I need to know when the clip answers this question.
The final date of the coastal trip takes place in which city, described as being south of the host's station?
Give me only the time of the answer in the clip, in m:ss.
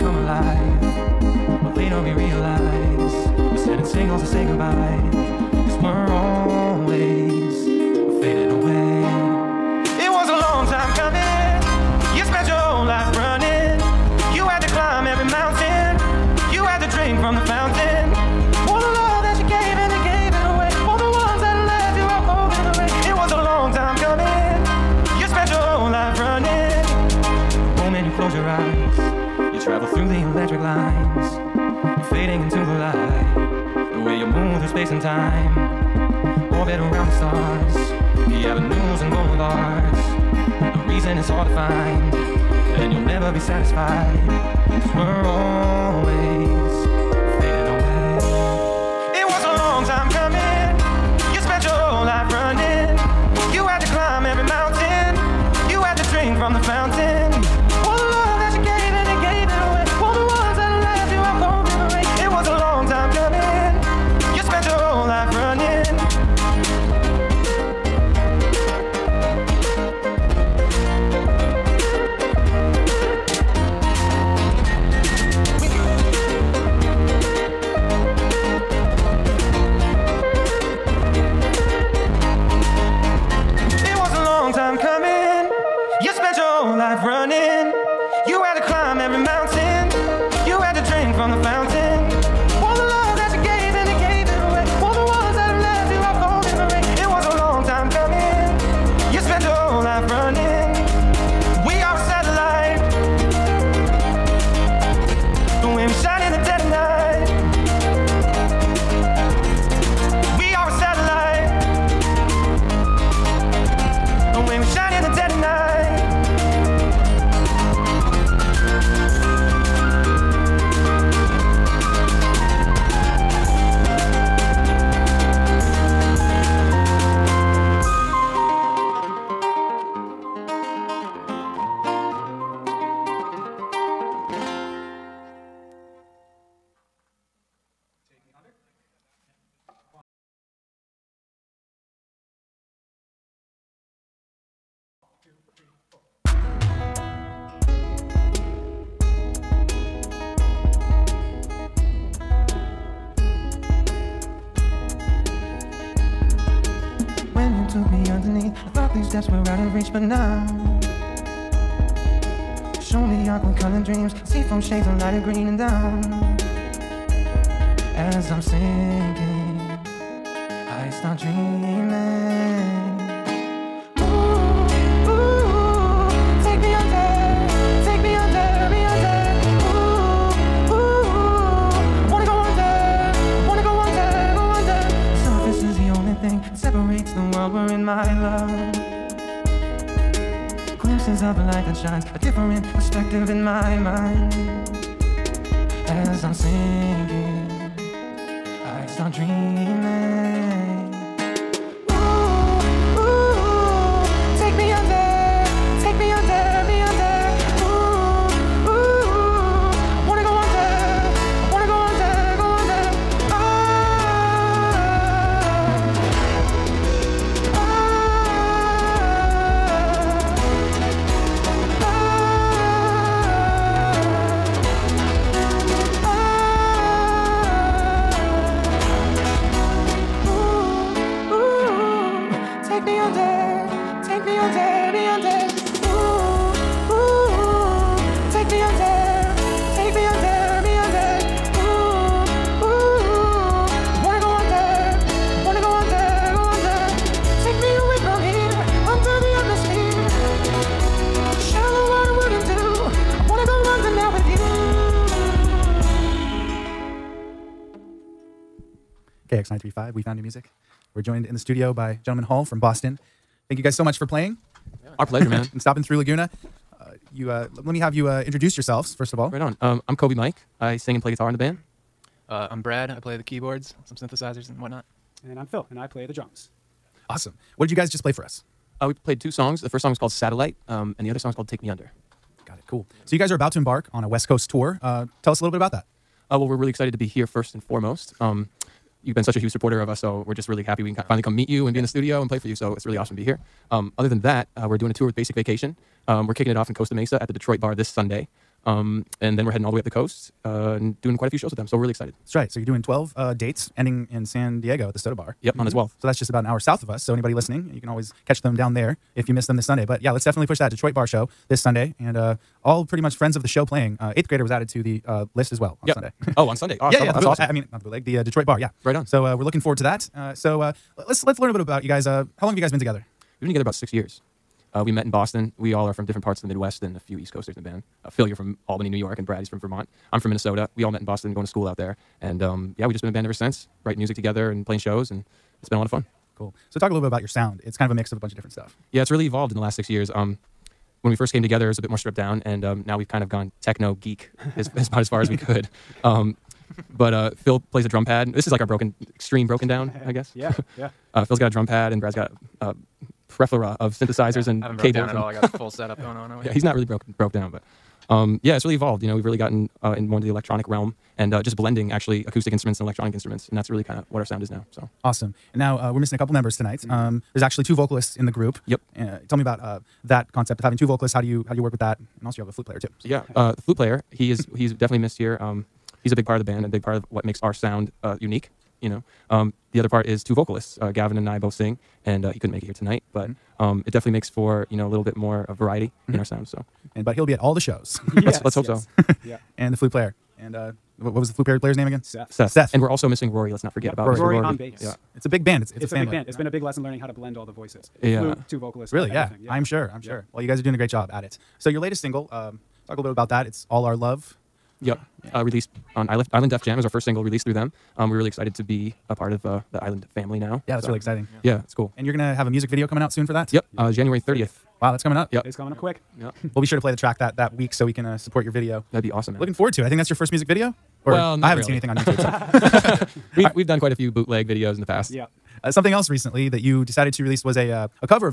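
5:04.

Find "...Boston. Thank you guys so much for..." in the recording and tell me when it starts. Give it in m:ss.
4:22.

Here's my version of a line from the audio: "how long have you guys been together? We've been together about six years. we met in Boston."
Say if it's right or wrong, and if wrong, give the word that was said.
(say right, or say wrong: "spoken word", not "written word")
right.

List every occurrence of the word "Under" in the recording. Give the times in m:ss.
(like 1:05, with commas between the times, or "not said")
4:41.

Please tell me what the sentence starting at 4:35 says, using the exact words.
And I'm Phil, and I play the drums.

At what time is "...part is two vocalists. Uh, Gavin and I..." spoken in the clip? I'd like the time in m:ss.
6:19.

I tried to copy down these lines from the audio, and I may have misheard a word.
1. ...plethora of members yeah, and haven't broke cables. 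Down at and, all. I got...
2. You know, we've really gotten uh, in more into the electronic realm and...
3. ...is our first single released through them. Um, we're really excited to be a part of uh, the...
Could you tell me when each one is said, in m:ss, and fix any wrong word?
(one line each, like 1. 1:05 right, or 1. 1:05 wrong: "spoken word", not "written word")
1. 5:53 wrong: "synthesizers", not "members"
2. 5:59 right
3. 6:46 right.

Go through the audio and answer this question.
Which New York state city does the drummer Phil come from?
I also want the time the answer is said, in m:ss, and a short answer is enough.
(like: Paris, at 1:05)
Albany, at 5:28.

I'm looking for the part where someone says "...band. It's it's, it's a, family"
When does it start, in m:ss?
6:35.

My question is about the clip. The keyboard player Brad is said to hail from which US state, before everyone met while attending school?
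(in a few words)
Vermont.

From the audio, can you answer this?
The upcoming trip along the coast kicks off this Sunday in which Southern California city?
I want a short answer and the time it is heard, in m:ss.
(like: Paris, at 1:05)
Costa Mesa, at 4:56.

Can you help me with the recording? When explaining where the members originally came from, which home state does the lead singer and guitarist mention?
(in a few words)
Minnesota.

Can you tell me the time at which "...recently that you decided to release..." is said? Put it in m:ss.
7:06.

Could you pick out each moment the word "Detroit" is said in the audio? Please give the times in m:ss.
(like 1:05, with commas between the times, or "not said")
4:57, 5:10, 5:18.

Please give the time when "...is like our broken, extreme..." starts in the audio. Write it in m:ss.
5:48.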